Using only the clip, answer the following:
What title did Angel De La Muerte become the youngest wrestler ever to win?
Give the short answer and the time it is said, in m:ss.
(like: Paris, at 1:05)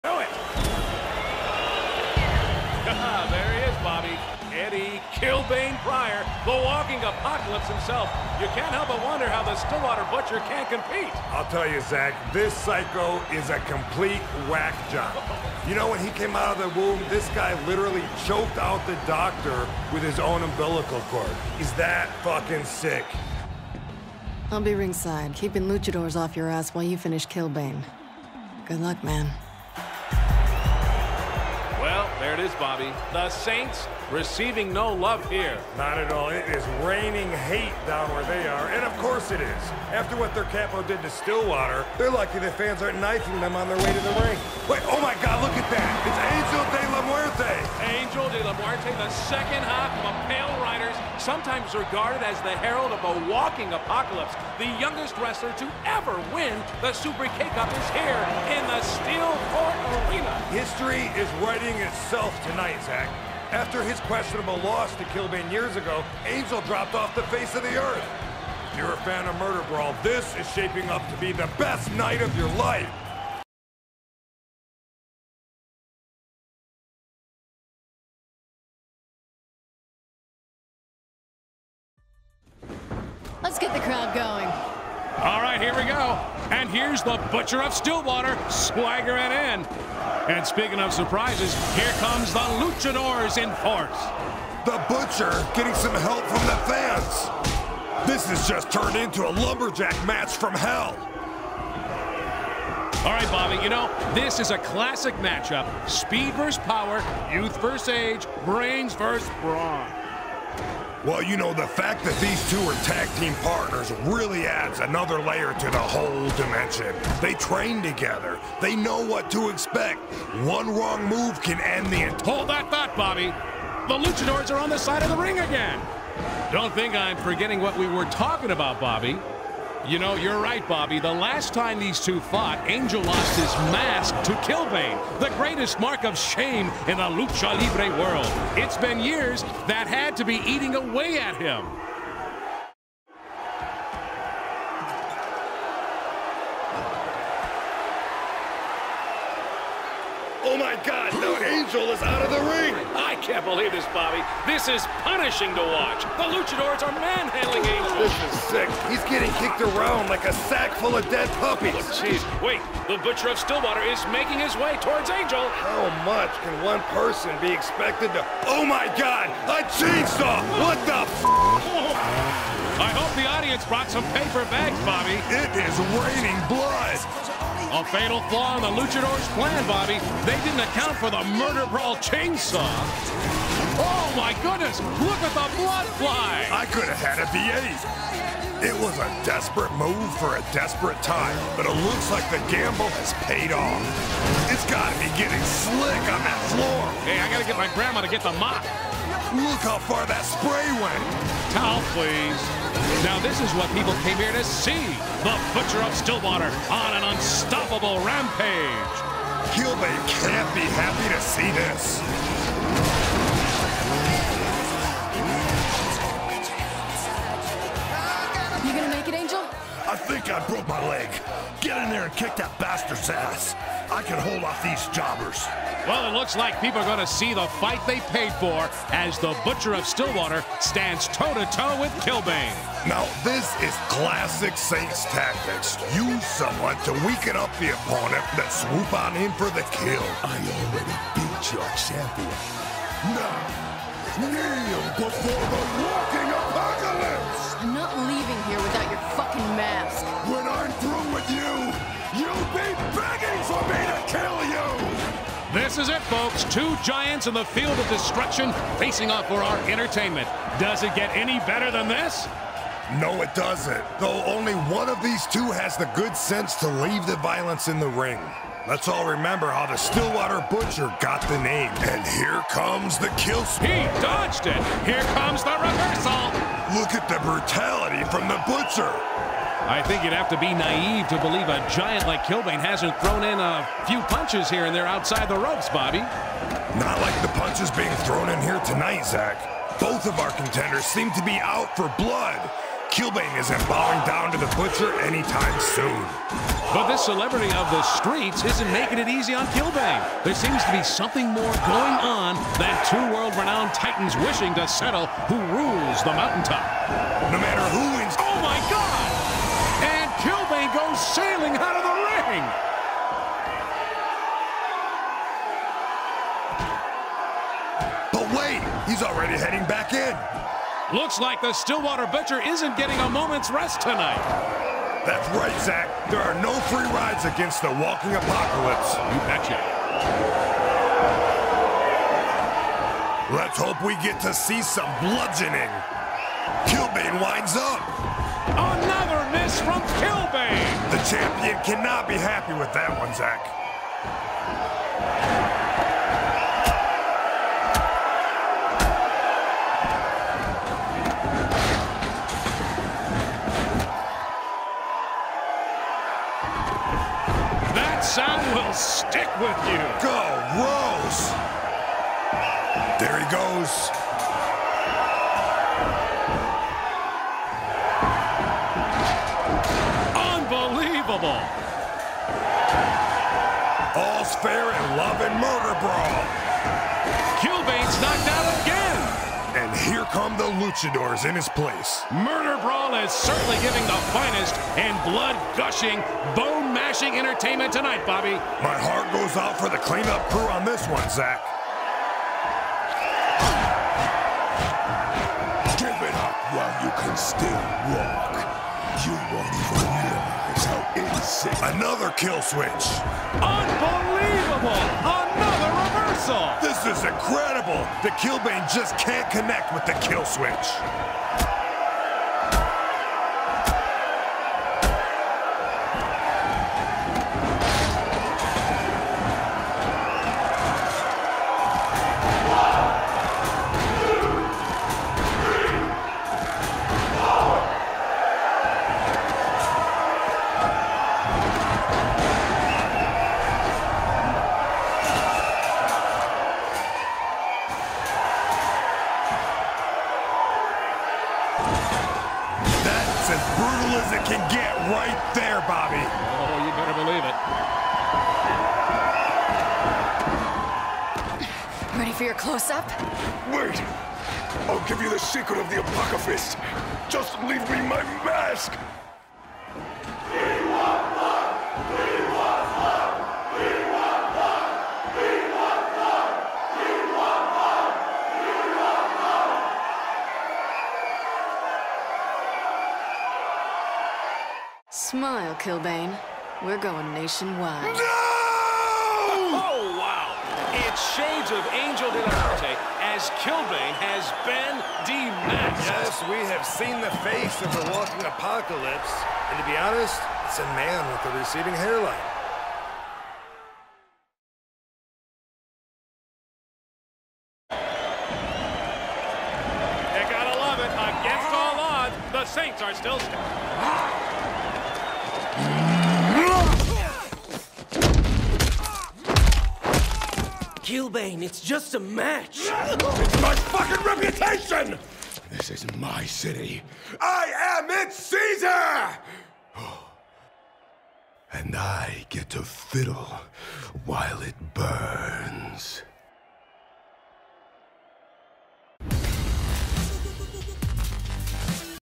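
Super K-Cup, at 0:56.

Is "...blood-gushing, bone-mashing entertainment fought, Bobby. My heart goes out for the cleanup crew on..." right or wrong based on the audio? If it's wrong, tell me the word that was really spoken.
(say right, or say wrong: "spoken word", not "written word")
wrong: "tonight", not "fought".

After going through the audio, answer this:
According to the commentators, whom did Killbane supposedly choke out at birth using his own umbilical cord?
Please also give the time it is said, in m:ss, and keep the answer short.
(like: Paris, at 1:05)
the doctor, at 0:18.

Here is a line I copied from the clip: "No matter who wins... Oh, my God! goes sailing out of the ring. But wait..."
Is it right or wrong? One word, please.
right.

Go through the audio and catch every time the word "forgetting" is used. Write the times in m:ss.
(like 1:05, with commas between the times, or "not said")
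2:07.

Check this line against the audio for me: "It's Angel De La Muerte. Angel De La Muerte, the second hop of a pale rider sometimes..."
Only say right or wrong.
right.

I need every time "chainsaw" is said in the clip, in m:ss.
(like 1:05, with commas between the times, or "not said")
2:49, 3:02.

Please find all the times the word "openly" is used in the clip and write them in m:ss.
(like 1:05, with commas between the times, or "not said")
not said.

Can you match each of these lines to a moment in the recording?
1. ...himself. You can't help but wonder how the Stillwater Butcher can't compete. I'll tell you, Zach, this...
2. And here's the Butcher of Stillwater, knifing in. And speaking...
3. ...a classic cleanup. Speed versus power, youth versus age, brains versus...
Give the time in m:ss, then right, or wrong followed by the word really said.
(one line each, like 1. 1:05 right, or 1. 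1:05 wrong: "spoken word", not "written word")
1. 0:07 right
2. 1:26 wrong: "swaggering", not "knifing"
3. 1:44 wrong: "matchup", not "cleanup".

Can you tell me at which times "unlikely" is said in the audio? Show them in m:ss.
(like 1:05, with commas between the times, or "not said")
not said.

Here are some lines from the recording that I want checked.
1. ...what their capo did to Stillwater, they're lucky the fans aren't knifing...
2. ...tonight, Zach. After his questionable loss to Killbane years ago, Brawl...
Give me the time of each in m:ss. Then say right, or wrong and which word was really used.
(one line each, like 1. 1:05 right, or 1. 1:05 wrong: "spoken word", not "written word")
1. 0:40 right
2. 1:02 wrong: "Angel", not "Brawl".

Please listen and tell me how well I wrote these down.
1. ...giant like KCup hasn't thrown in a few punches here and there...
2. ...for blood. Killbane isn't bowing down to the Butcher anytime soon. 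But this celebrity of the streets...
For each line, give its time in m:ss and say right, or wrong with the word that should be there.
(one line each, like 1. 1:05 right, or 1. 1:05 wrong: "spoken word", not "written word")
1. 4:41 wrong: "Killbane", not "KCup"
2. 4:51 right.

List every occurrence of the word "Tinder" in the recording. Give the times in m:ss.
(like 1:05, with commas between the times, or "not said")
not said.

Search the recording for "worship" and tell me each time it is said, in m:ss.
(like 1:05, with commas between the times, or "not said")
not said.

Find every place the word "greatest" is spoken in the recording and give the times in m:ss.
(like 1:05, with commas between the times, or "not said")
2:15.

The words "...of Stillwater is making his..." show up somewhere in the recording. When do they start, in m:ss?
2:43.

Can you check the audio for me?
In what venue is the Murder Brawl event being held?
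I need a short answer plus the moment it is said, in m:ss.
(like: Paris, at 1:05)
Steel Court Arena, at 0:58.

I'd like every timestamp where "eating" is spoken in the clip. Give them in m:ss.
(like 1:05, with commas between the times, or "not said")
2:20.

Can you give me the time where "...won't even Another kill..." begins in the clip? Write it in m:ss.
6:39.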